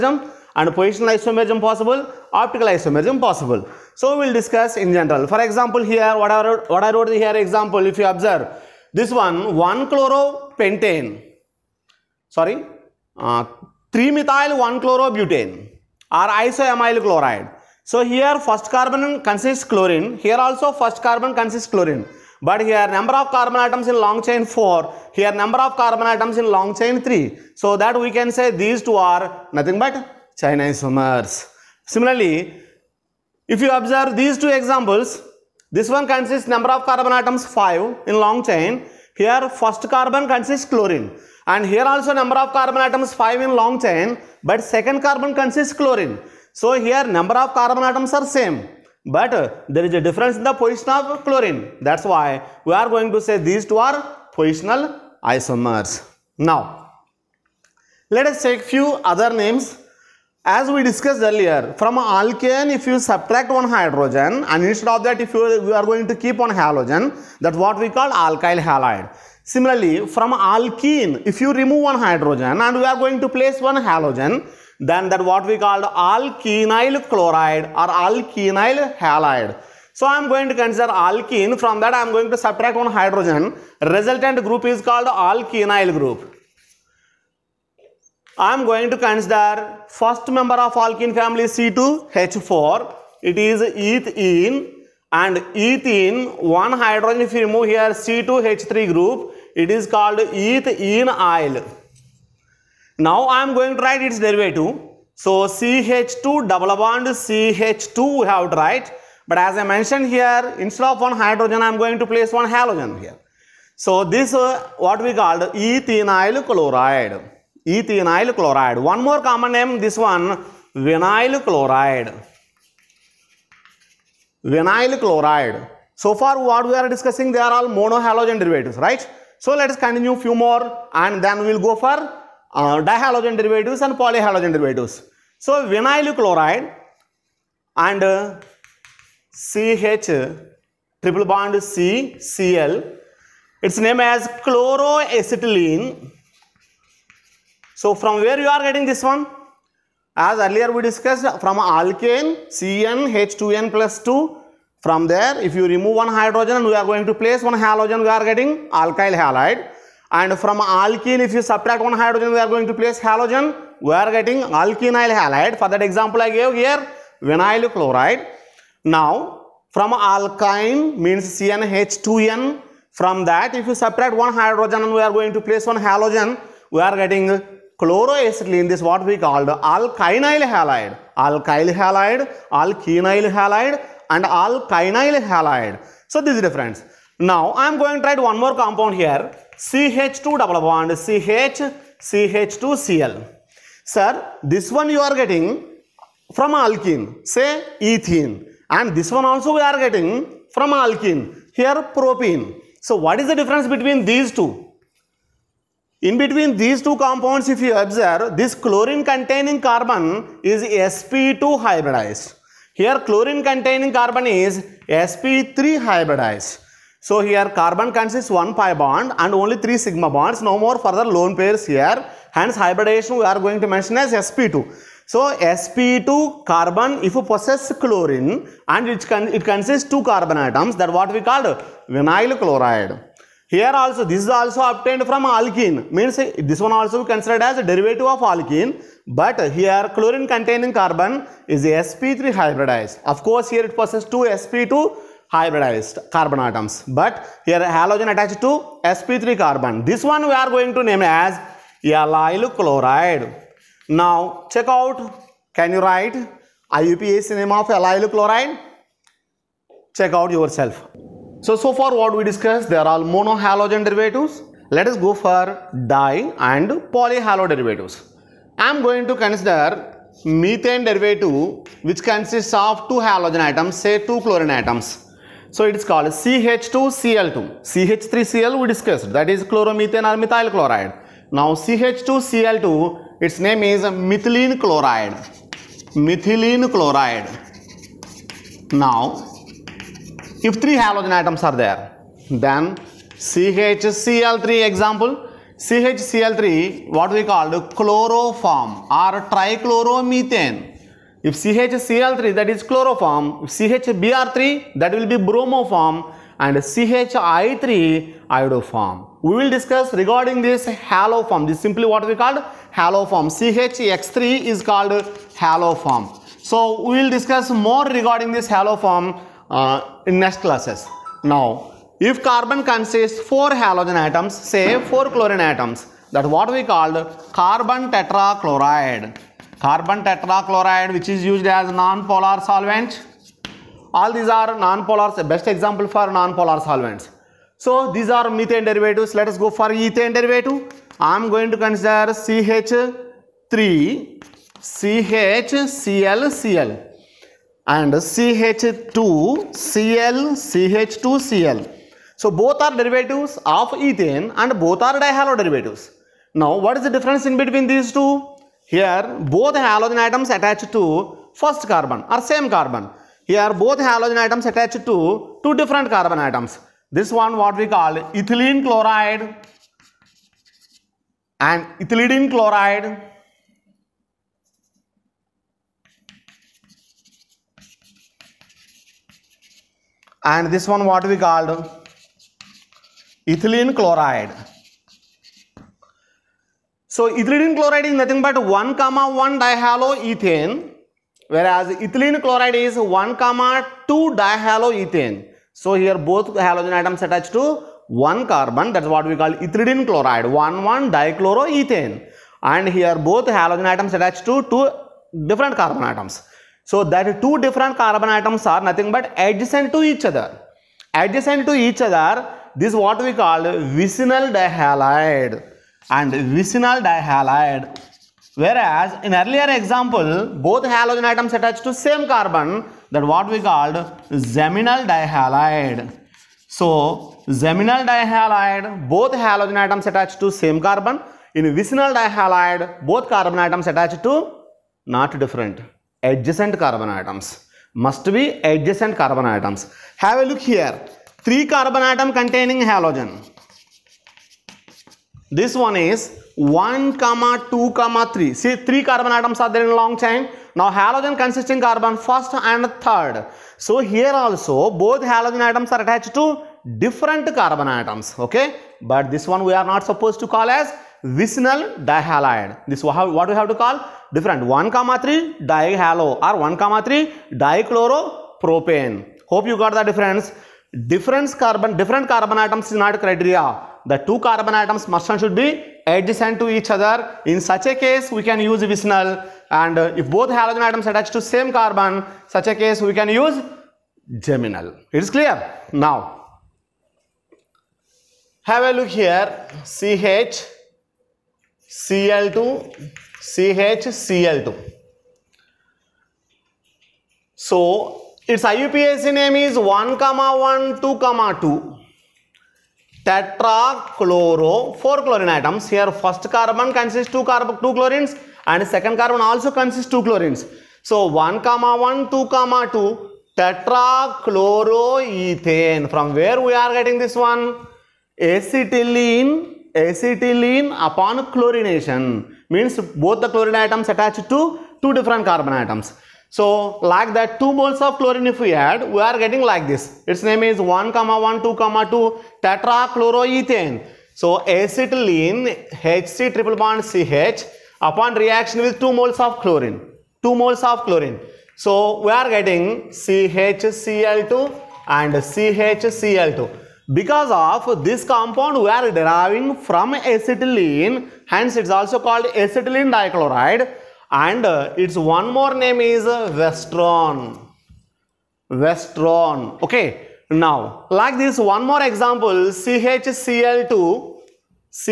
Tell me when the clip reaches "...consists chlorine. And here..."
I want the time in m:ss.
0:40.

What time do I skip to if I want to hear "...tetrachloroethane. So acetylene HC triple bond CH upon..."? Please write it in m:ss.
8:52.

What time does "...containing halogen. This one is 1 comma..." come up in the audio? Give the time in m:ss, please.
7:22.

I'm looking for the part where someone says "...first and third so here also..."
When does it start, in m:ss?
7:31.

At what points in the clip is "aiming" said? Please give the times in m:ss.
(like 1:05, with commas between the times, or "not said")
not said.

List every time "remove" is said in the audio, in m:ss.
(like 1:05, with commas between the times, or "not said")
1:11, 1:37, 2:35.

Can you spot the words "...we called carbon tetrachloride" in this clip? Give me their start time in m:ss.
5:26.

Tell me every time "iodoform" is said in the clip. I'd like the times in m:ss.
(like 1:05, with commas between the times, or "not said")
5:08.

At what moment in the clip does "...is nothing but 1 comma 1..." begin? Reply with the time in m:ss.
6:27.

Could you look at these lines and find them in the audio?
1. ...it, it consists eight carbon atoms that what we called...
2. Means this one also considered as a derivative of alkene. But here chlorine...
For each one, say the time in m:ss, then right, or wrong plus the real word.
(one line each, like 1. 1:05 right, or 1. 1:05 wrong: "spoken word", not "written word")
1. 3:48 wrong: "two", not "eight"
2. 3:55 right.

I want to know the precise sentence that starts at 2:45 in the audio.
For that example I gave here vinyl chloride.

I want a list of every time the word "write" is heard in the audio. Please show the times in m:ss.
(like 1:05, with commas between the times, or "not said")
1:43, 1:48, 3:08, 4:15.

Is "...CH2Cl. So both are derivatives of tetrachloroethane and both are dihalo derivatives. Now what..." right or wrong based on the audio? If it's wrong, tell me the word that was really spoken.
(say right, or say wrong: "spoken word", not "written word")
wrong: "ethane", not "tetrachloroethane".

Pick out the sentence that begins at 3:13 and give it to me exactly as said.
Sir, this one you are getting from alkene, say ethene.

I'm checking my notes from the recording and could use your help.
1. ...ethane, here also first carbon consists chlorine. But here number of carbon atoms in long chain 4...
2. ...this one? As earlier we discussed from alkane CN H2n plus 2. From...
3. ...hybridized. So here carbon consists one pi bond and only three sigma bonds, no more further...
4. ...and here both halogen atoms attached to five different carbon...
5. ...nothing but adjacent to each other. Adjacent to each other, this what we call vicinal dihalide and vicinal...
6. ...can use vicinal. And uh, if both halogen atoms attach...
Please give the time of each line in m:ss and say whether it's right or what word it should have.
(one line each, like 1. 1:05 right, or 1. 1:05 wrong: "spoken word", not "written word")
1. 0:19 wrong: "chlorine", not "ethane"
2. 2:28 right
3. 3:35 right
4. 6:42 wrong: "two", not "five"
5. 6:48 right
6. 7:58 right.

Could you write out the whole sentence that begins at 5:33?
All these are non-polar, best example for non-polar solvents.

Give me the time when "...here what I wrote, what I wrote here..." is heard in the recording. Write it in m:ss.
0:05.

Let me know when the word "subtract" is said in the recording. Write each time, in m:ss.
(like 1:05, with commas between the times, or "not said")
1:03, 1:22, 2:41, 2:53.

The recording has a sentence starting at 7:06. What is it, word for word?
So geminal dihalide, both halogen atoms attached to same carbon.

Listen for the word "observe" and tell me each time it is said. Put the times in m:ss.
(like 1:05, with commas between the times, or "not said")
0:08, 0:33, 3:27.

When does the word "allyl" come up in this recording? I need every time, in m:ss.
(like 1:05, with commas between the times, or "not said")
4:11, 4:17.